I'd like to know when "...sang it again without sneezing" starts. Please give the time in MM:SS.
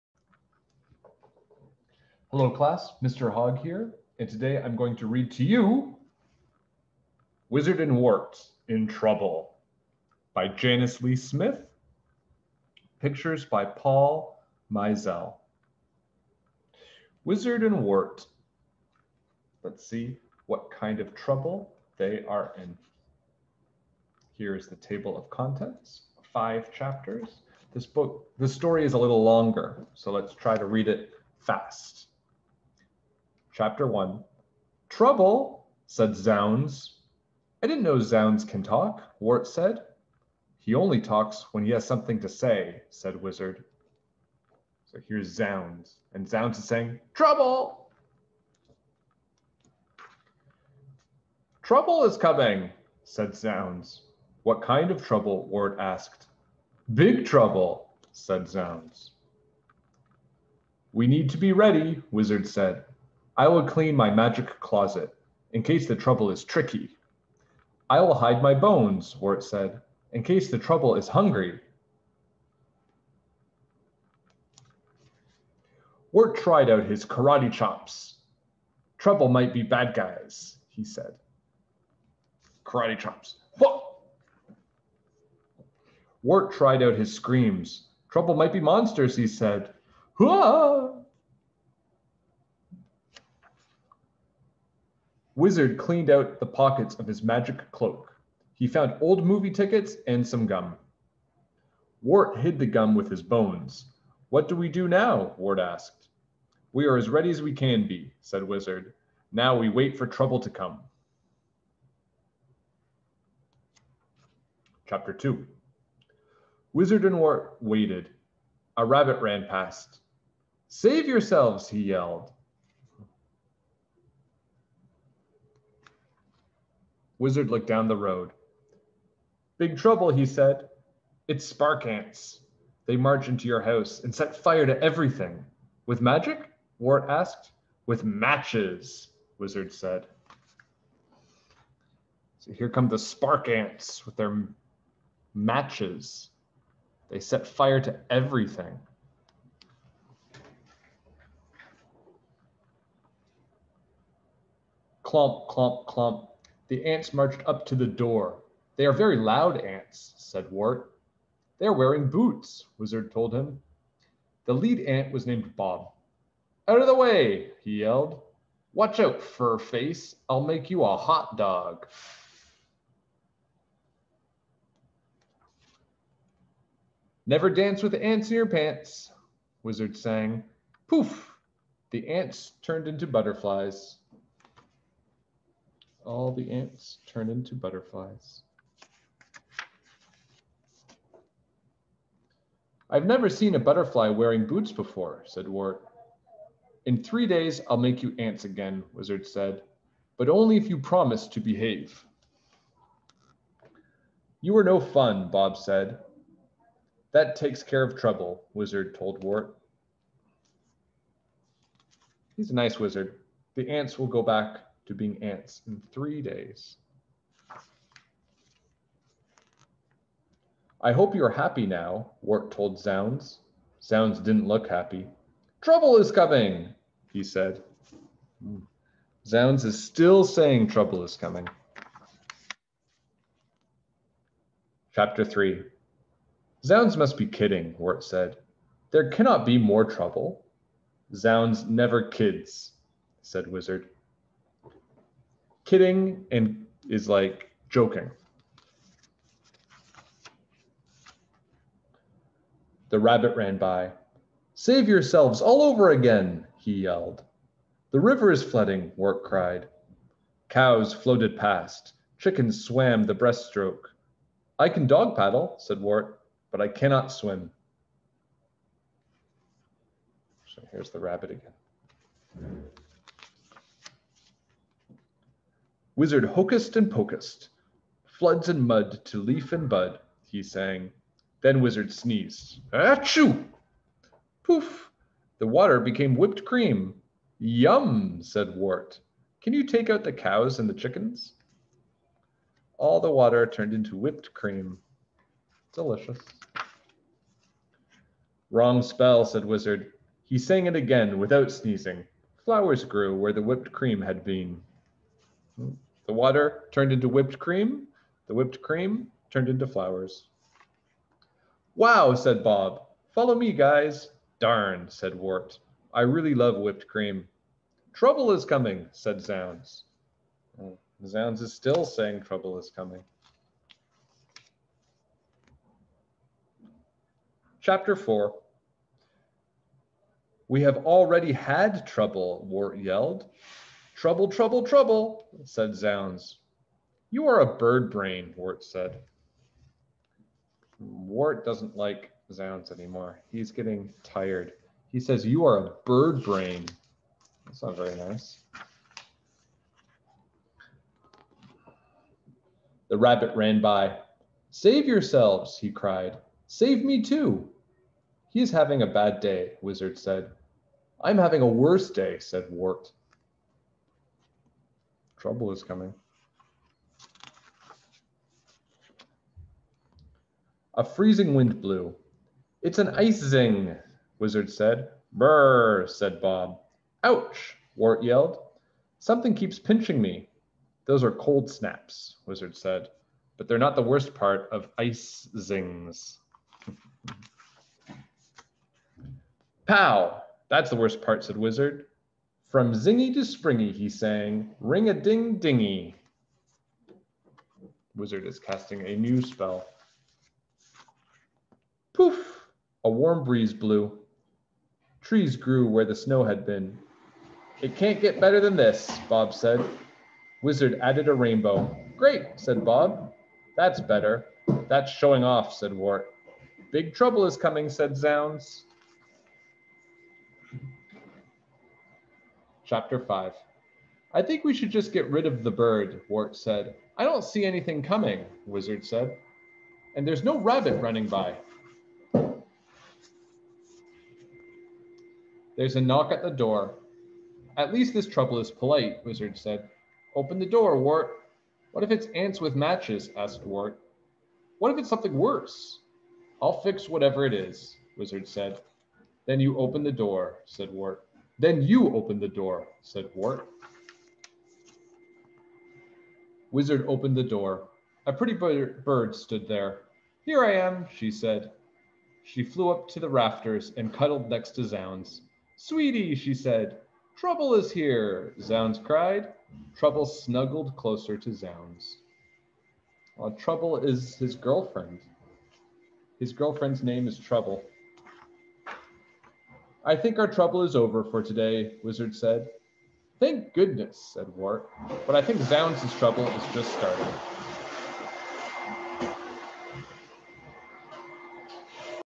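05:00.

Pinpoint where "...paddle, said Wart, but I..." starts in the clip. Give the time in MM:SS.
04:25.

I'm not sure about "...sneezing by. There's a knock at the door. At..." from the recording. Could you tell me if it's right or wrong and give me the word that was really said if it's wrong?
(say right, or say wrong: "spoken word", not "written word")
wrong: "running", not "sneezing".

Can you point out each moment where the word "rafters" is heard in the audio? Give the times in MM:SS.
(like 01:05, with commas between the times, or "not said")
07:43.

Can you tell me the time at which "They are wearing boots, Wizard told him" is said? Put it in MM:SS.
02:41.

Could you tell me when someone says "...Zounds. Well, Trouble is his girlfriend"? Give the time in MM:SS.
07:51.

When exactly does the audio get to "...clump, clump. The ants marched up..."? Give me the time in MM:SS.
02:35.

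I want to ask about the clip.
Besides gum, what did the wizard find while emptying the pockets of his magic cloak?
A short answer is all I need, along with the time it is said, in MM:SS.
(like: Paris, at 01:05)
old movie tickets, at 01:39.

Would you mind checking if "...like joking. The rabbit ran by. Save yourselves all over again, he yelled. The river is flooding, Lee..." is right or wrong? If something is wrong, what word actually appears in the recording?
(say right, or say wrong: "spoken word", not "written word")
wrong: "Wart", not "Lee".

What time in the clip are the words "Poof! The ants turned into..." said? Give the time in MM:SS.
03:00.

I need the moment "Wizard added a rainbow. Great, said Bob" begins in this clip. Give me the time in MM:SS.
06:50.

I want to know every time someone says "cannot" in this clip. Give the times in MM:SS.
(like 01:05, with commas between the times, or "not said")
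03:59, 04:26.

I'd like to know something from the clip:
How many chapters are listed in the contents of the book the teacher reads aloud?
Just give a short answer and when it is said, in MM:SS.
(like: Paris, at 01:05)
5, at 00:26.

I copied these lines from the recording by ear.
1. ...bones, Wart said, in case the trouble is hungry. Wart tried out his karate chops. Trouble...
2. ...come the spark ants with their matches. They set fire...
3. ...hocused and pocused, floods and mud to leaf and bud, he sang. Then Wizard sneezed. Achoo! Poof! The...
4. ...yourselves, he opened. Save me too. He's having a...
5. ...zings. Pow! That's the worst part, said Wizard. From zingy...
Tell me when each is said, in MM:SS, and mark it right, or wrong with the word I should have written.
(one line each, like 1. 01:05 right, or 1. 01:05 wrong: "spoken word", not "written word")
1. 01:08 right
2. 02:22 right
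3. 04:36 right
4. 05:54 wrong: "cried", not "opened"
5. 06:25 right.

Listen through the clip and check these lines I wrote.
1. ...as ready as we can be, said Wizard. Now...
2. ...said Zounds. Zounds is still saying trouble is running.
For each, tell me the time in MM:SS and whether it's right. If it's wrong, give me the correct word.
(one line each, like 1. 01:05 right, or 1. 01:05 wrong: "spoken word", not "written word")
1. 01:46 right
2. 05:18 wrong: "coming", not "running".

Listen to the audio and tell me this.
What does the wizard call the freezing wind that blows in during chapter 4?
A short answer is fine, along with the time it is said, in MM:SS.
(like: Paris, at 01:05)
an ice zing, at 06:12.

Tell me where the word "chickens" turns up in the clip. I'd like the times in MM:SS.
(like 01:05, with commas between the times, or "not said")
04:22, 04:50.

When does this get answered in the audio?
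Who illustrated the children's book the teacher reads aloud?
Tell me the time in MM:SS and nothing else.
00:13.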